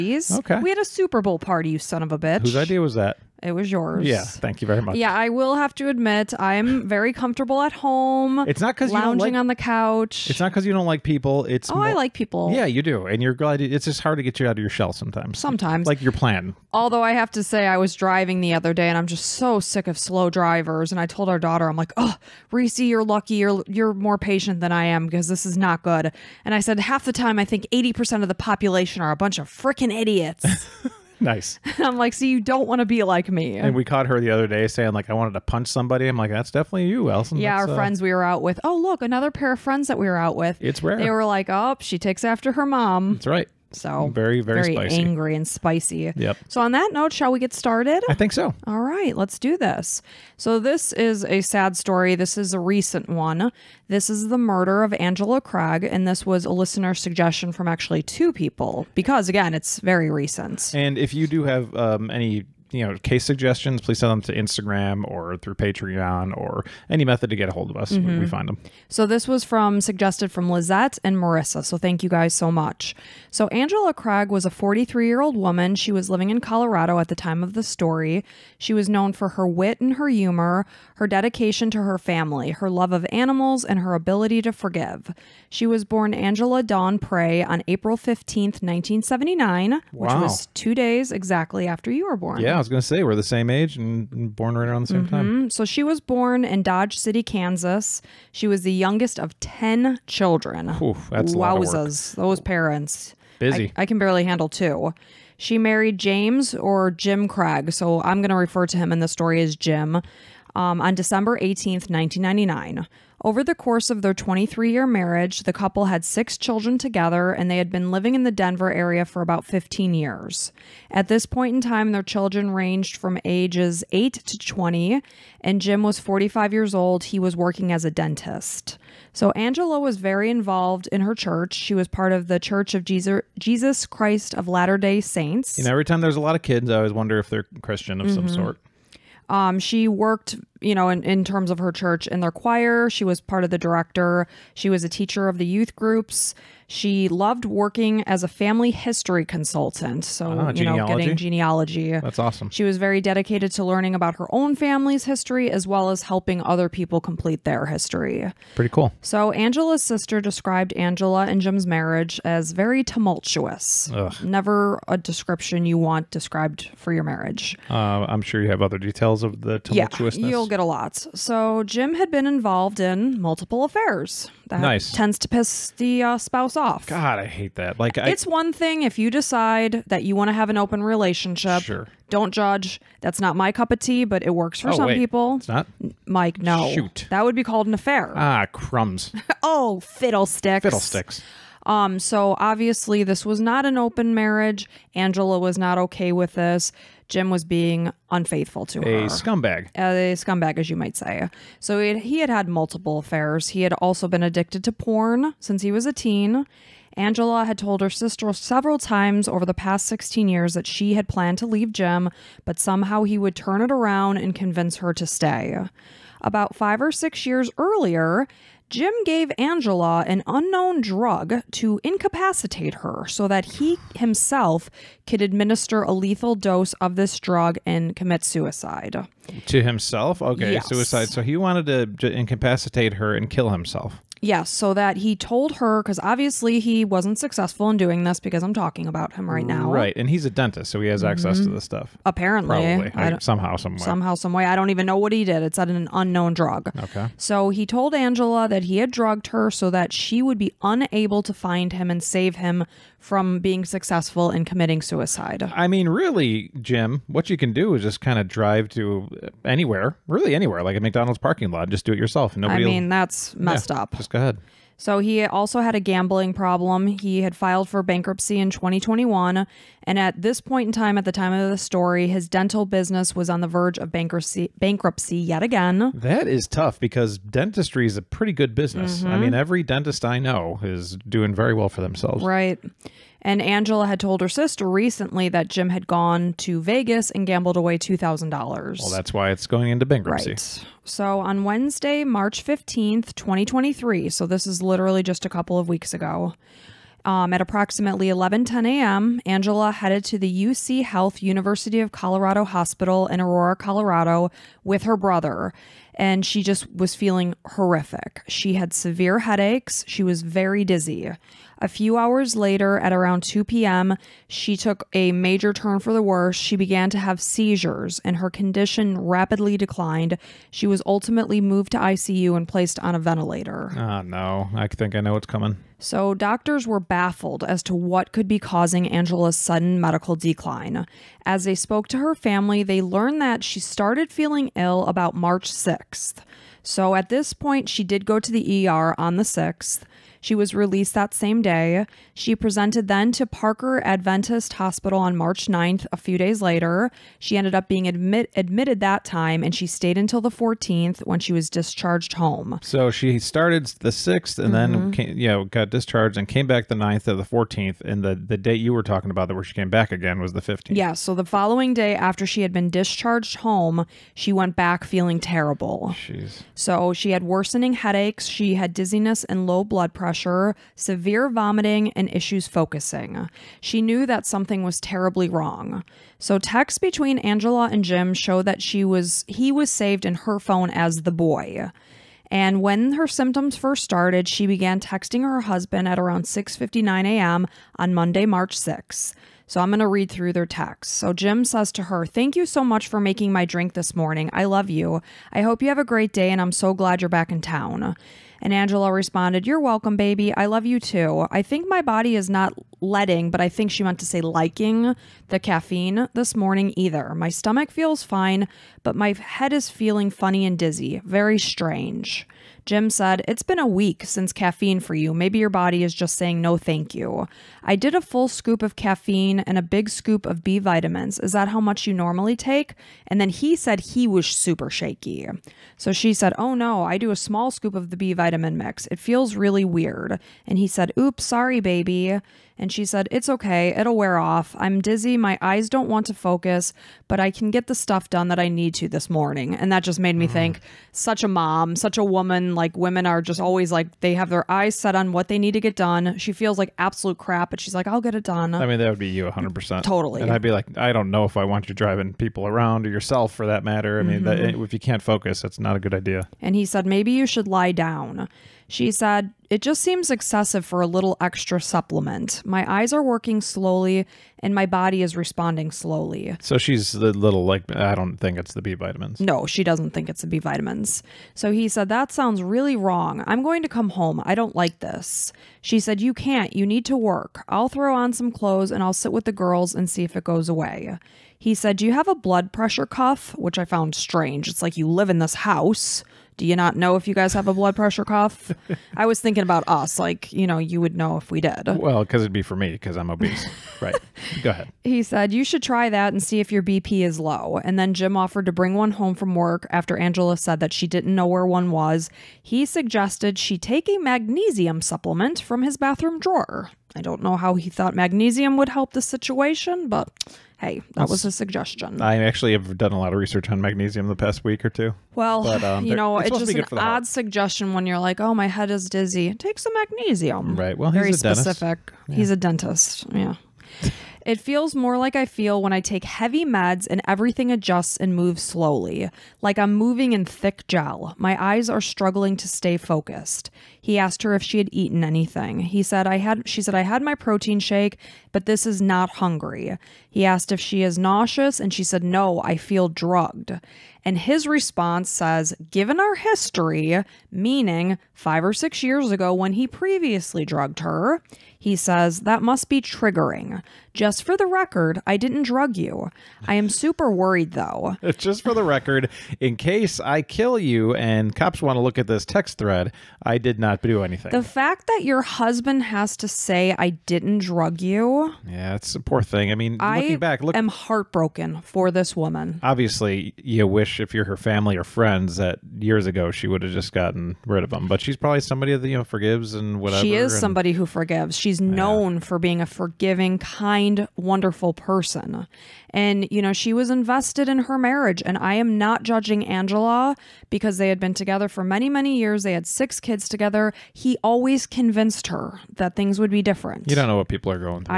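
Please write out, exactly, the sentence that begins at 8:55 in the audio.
He said I had she said I had my protein shake, but this is not hungry.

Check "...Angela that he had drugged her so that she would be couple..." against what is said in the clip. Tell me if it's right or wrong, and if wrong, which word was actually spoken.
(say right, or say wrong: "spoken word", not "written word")
wrong: "unable", not "couple".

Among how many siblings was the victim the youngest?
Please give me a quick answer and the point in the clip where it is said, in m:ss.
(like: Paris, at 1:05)
10, at 1:39.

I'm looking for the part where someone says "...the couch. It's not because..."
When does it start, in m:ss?
0:09.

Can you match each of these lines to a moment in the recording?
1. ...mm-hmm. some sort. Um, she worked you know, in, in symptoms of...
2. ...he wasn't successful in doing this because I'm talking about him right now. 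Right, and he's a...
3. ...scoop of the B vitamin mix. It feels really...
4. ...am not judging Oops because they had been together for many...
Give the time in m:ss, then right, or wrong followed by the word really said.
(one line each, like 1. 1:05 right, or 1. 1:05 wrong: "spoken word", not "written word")
1. 2:18 wrong: "terms", not "symptoms"
2. 3:56 right
3. 7:07 right
4. 9:48 wrong: "Angela", not "Oops".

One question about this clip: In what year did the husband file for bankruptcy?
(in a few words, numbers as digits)
2021.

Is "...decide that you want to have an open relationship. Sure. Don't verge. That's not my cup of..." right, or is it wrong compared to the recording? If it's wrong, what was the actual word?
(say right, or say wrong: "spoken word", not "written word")
wrong: "judge", not "verge".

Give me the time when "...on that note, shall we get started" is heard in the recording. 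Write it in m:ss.
0:46.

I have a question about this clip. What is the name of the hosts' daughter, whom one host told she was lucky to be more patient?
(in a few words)
Reese.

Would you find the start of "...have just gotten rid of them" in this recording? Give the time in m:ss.
9:36.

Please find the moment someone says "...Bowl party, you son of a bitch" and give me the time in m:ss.
0:01.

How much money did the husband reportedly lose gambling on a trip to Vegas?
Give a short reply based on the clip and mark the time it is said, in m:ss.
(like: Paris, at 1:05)
$2,000, at 4:47.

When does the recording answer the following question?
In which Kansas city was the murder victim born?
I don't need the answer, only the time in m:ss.
1:36.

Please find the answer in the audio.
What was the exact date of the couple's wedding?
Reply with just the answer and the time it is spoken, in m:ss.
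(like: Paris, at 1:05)
December 18th, 1999, at 1:50.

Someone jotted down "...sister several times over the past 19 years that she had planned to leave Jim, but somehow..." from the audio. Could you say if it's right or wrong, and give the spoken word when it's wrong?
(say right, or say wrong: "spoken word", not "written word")
wrong: "16", not "19".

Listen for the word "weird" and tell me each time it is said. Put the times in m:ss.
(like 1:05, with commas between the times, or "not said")
7:09.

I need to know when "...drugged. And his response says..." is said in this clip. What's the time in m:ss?
9:02.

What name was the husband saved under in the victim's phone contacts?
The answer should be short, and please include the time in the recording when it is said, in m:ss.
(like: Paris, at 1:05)
The boy, at 6:21.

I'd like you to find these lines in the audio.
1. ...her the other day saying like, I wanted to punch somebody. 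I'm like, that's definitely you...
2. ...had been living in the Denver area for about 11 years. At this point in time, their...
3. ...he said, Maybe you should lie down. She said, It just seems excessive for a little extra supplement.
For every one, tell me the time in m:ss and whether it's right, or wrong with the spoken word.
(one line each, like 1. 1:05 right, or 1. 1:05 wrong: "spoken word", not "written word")
1. 0:34 right
2. 1:57 wrong: "15", not "11"
3. 7:36 right.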